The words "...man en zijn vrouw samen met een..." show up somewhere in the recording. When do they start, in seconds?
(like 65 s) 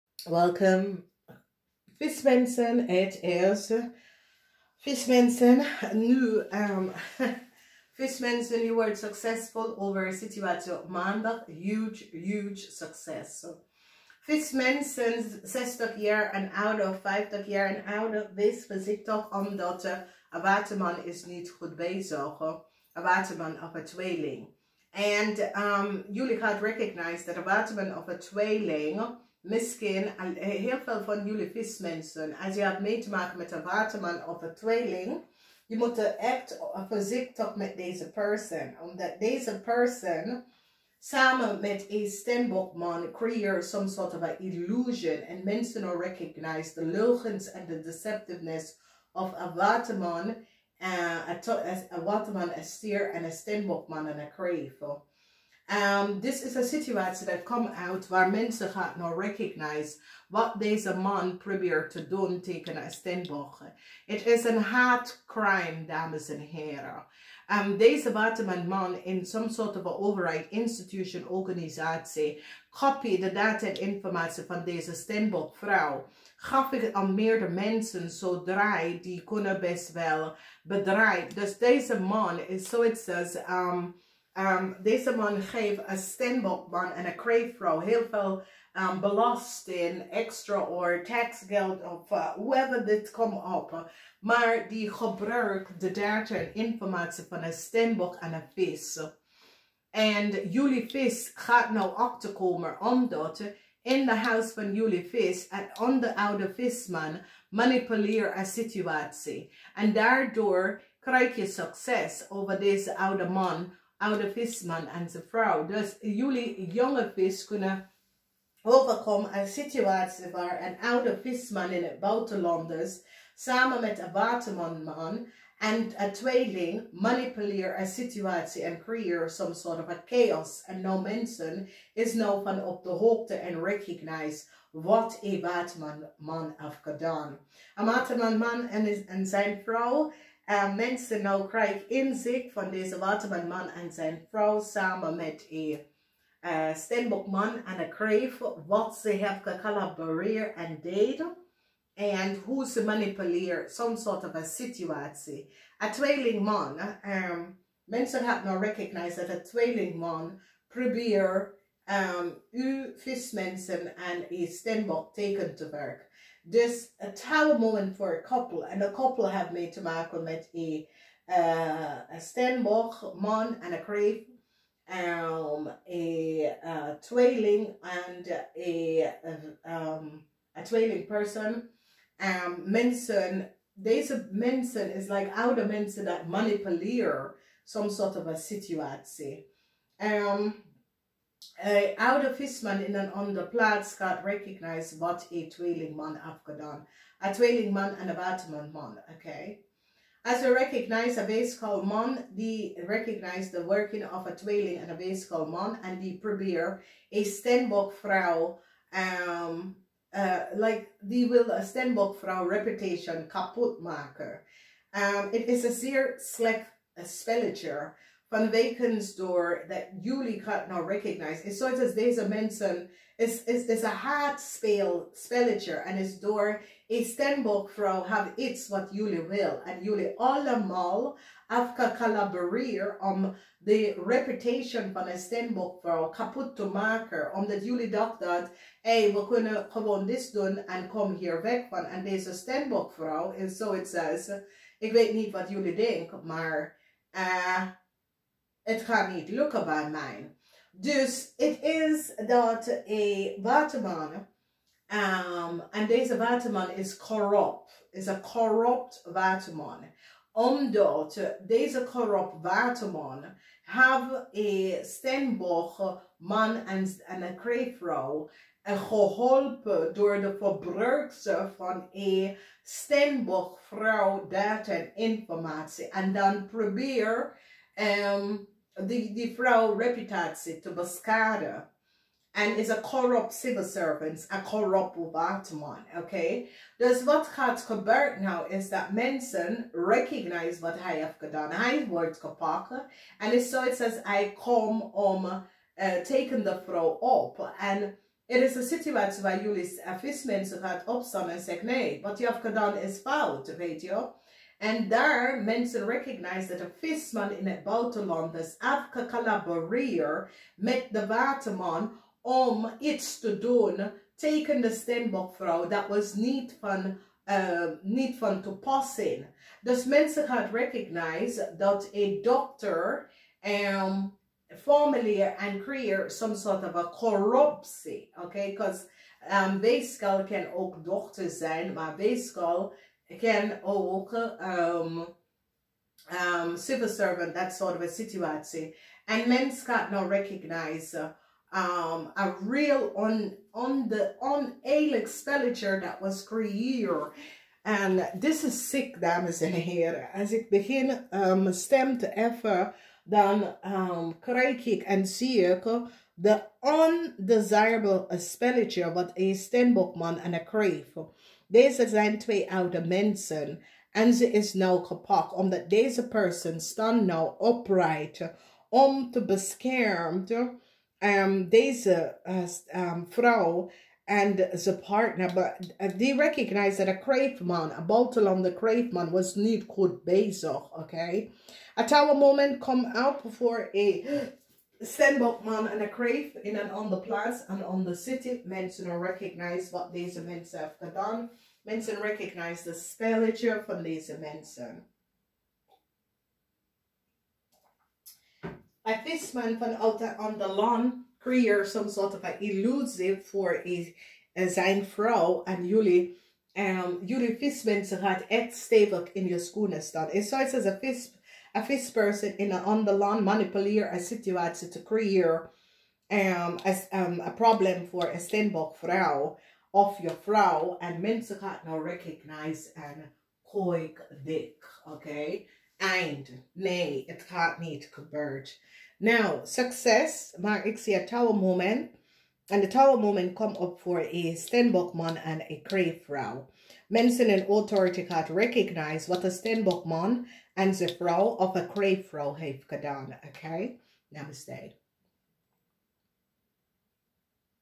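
143 s.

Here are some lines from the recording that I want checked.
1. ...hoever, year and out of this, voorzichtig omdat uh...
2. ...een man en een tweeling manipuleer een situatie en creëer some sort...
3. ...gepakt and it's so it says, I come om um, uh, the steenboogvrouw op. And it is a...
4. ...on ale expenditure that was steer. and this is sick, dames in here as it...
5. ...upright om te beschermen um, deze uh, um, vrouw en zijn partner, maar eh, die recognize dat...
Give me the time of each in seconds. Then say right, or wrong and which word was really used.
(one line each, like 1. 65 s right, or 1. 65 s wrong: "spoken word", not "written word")
1. 17 s wrong: "ouder", not "hoever"
2. 123 s right
3. 292 s wrong: "vrouw", not "steenboogvrouw"
4. 344 s wrong: "creëer", not "steer"
5. 367 s right.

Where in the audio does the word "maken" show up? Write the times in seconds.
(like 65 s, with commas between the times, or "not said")
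33 s, 213 s, 236 s.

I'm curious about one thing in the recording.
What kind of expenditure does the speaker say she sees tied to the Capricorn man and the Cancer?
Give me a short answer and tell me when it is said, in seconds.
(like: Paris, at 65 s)
undesirable expenditure, at 356 s.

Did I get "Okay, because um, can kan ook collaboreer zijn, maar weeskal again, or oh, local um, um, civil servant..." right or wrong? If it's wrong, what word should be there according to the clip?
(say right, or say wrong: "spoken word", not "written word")
wrong: "dochter", not "collaboreer".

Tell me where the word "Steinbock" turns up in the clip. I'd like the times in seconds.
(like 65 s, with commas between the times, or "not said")
172 s, 418 s.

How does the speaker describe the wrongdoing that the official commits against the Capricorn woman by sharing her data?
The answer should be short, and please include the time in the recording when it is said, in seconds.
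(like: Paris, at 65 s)
hard crime, at 64 s.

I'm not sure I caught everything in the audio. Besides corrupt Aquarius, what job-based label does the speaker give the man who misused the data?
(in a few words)
corrupt civil servant.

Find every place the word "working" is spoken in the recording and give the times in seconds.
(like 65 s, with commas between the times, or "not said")
203 s.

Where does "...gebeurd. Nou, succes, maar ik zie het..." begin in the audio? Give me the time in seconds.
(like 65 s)
427 s.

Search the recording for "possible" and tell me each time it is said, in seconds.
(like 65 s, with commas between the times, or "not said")
not said.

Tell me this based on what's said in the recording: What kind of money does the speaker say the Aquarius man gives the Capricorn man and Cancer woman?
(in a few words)
taxgeld.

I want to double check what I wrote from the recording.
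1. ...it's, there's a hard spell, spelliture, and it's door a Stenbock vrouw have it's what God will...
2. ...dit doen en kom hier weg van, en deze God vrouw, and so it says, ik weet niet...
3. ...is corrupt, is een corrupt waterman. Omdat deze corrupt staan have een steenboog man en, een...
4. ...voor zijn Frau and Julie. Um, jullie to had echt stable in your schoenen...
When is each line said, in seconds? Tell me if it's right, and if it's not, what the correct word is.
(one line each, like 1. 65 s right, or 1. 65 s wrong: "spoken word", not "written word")
1. 223 s wrong: "Julie", not "God"
2. 240 s wrong: "Stenbock", not "God"
3. 256 s wrong: "waterman", not "staan"
4. 404 s right.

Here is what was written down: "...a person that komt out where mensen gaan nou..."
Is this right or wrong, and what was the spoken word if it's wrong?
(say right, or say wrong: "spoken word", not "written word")
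wrong: "situation", not "person".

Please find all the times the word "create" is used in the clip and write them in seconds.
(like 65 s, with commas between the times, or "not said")
325 s, 414 s.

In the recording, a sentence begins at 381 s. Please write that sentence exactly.
At our moment, come out voor a Stenbok man and a crave in and on the place and on the city.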